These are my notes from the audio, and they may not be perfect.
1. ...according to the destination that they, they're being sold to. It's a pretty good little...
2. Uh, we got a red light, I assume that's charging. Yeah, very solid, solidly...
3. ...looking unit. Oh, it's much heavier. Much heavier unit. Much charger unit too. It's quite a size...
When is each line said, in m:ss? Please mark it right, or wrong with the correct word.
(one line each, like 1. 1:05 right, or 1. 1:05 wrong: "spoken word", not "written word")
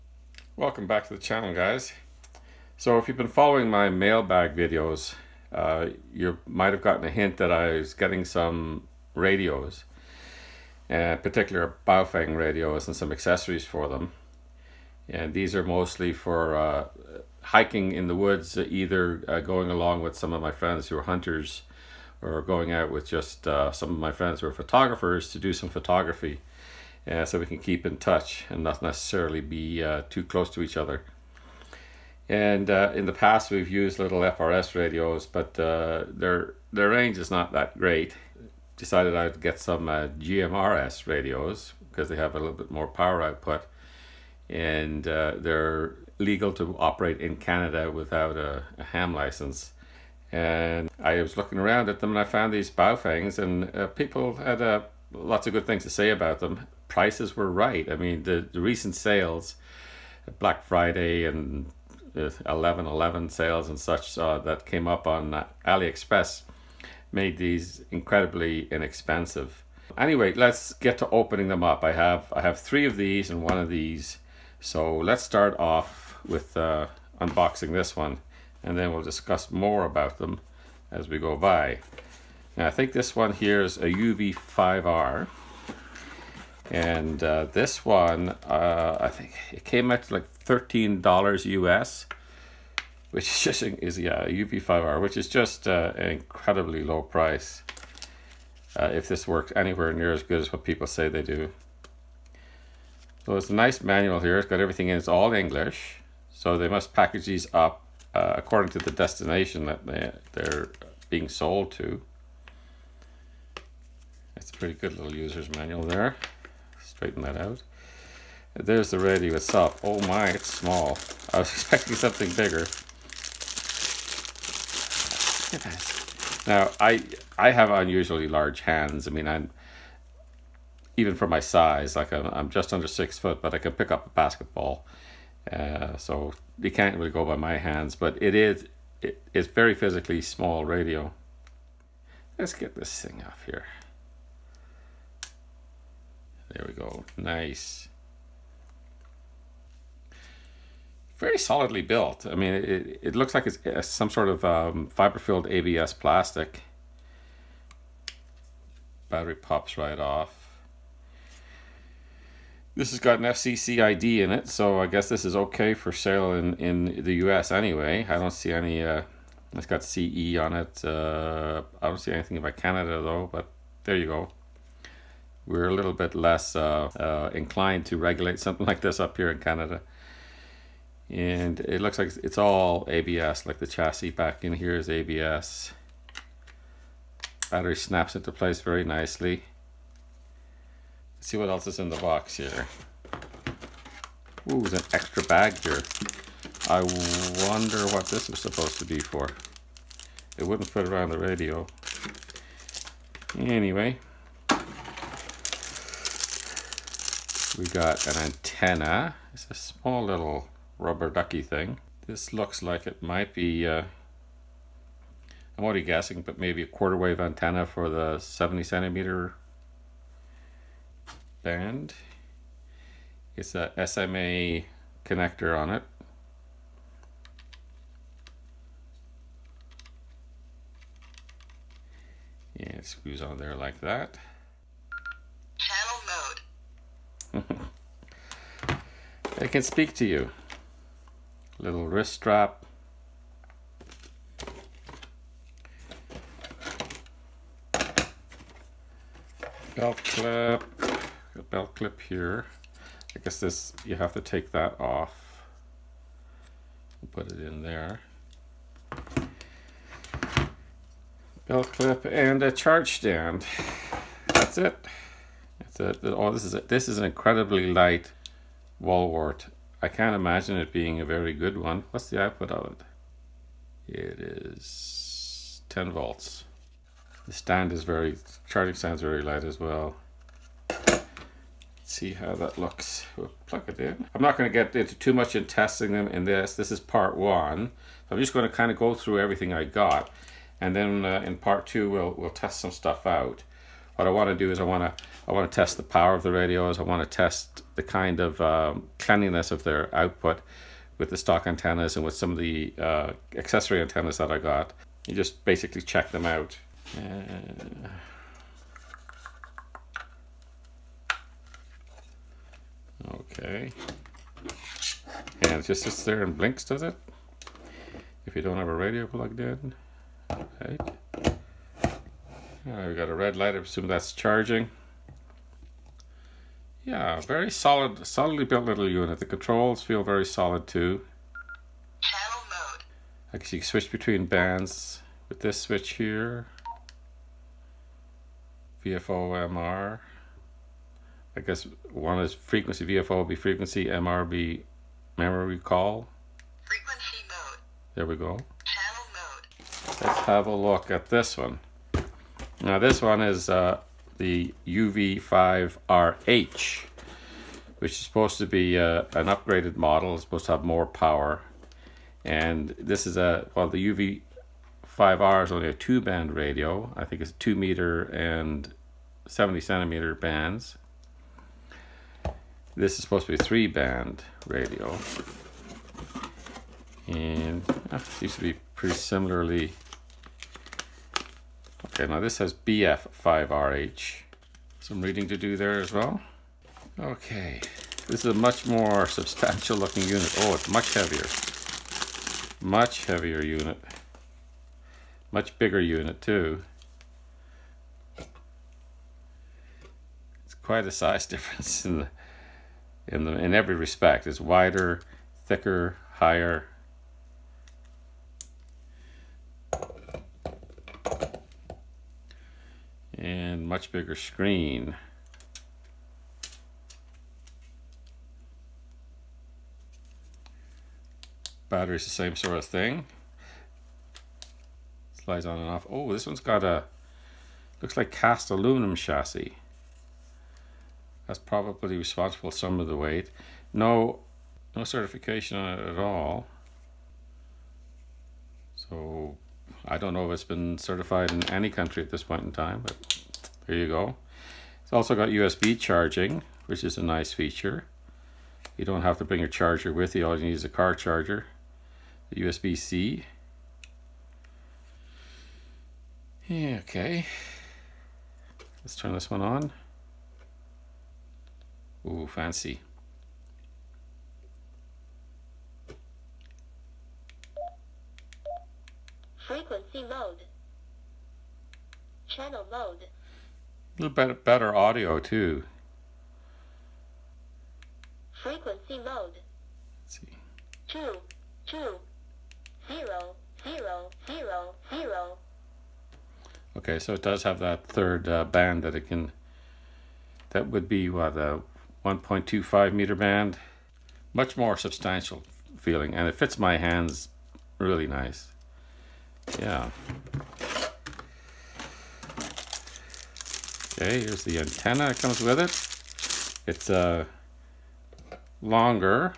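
1. 1:48 right
2. 5:22 right
3. 6:29 wrong: "bigger", not "charger".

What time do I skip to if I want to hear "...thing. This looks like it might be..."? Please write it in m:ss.
3:31.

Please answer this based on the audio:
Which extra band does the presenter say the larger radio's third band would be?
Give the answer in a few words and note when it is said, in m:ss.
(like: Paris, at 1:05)
1.25 meter band, at 8:12.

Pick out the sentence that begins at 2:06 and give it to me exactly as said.
Now, I I have unusually large hands.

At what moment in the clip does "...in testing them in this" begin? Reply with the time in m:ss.
4:45.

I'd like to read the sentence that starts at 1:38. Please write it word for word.
Uh, if this works anywhere near as good as what people say they do.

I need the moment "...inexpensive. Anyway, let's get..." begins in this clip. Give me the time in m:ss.
1:08.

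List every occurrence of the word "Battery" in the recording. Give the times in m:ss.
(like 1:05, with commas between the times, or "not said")
2:39, 3:07, 7:01.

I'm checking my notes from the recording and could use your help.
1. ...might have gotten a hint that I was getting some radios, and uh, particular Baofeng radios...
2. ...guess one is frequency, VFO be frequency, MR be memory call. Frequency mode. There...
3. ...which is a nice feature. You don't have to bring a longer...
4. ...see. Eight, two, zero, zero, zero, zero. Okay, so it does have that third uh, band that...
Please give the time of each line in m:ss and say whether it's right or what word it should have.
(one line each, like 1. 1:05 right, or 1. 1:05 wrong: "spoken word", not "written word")
1. 0:06 right
2. 5:41 right
3. 7:26 wrong: "charger", not "longer"
4. 8:00 wrong: "Two", not "Eight".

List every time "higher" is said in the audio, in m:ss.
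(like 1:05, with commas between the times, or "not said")
6:46.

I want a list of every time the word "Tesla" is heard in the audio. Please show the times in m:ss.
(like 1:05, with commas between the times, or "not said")
not said.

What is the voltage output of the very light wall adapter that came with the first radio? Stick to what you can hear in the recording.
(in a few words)
10 volts.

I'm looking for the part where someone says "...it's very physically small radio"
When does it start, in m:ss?
2:19.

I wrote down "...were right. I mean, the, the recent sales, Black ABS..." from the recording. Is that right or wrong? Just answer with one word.
wrong.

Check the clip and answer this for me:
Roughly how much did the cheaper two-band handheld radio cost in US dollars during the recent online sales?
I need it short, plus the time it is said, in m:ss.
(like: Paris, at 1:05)
$13, at 1:30.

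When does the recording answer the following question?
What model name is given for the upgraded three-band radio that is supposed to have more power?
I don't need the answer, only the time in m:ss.
5:54.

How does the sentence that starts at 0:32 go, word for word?
And uh, in the past, we've used little FRS radios, but uh, their their range is not that great.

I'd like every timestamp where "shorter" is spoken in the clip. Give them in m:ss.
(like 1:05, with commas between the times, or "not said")
not said.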